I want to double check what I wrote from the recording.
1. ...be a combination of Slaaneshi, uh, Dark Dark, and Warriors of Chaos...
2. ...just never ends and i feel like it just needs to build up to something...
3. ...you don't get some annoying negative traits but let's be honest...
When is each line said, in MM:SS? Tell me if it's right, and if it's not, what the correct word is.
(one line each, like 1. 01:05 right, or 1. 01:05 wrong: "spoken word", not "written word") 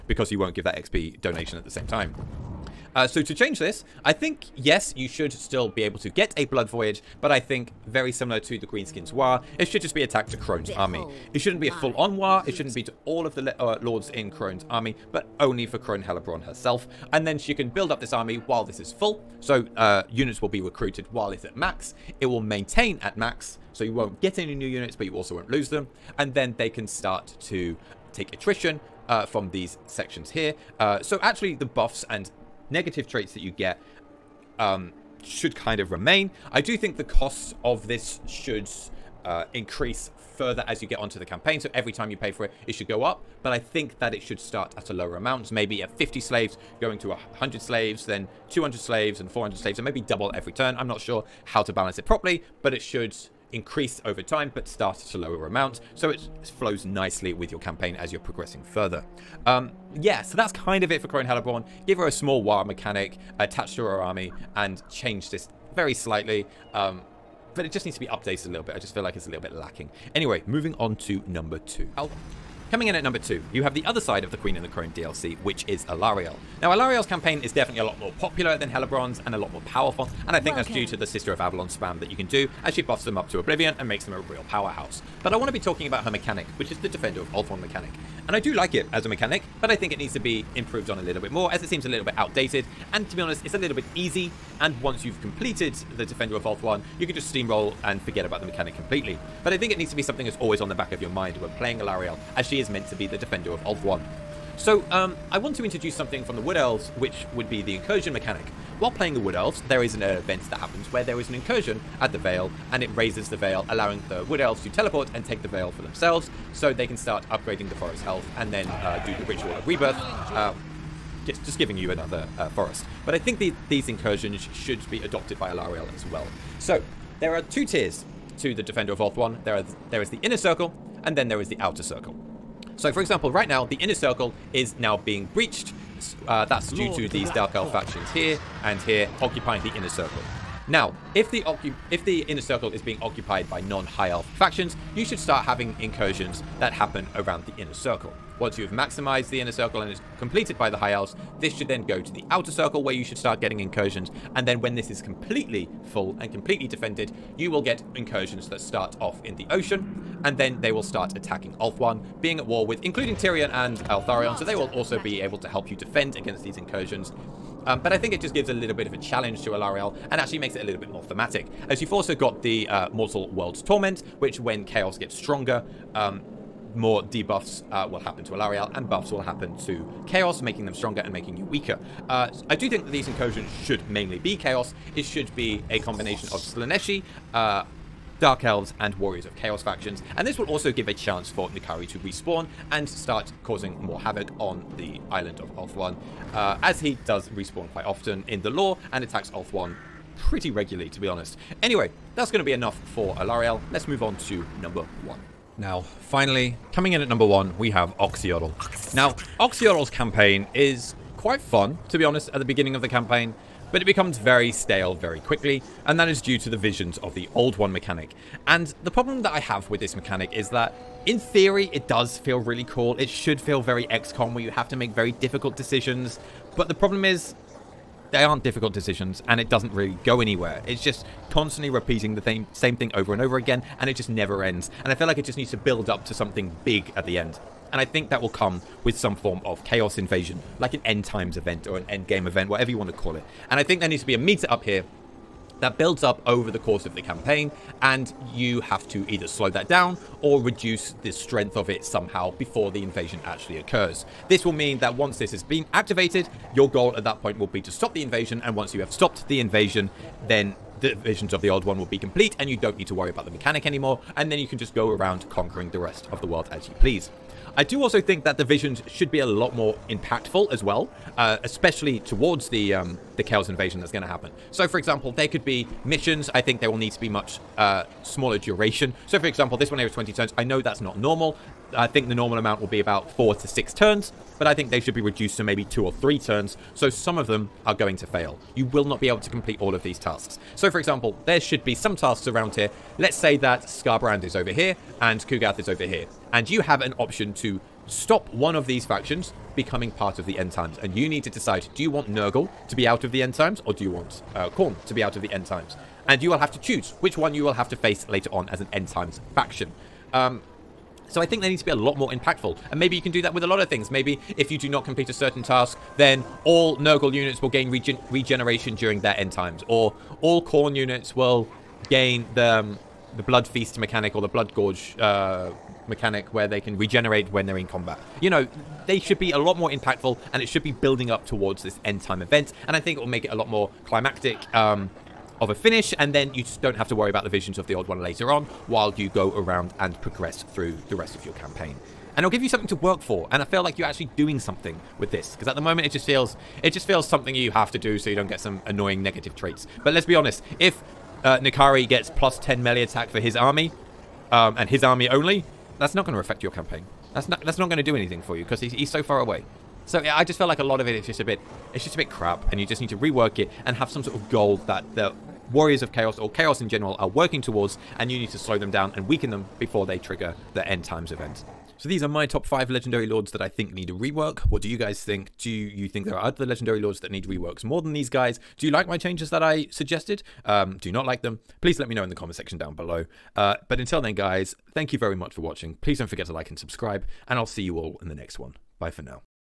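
1. 03:05 wrong: "Elves", not "Dark"
2. 03:53 right
3. 05:48 right.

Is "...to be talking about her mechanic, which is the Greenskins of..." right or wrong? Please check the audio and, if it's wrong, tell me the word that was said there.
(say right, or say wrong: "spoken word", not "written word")
wrong: "Defender", not "Greenskins".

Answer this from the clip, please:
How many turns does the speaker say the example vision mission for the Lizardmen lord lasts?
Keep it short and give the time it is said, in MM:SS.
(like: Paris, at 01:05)
20 turns, at 04:39.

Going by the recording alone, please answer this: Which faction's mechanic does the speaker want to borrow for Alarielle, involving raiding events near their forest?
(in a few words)
incursion mechanic.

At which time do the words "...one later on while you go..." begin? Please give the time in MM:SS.
05:37.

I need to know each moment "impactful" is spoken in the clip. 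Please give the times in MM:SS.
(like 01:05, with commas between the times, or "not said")
04:29, 05:12, 05:29.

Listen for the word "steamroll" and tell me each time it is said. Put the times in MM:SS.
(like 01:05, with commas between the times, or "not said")
01:37.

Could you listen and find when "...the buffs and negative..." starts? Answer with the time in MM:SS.
00:31.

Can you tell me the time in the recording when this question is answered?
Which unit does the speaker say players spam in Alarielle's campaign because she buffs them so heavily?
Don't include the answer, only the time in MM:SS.
01:21.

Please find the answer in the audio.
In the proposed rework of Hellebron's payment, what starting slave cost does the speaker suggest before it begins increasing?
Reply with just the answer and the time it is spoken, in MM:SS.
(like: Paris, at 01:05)
50 slaves, at 00:45.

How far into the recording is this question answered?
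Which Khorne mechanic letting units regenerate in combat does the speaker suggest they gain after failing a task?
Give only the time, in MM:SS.
05:23.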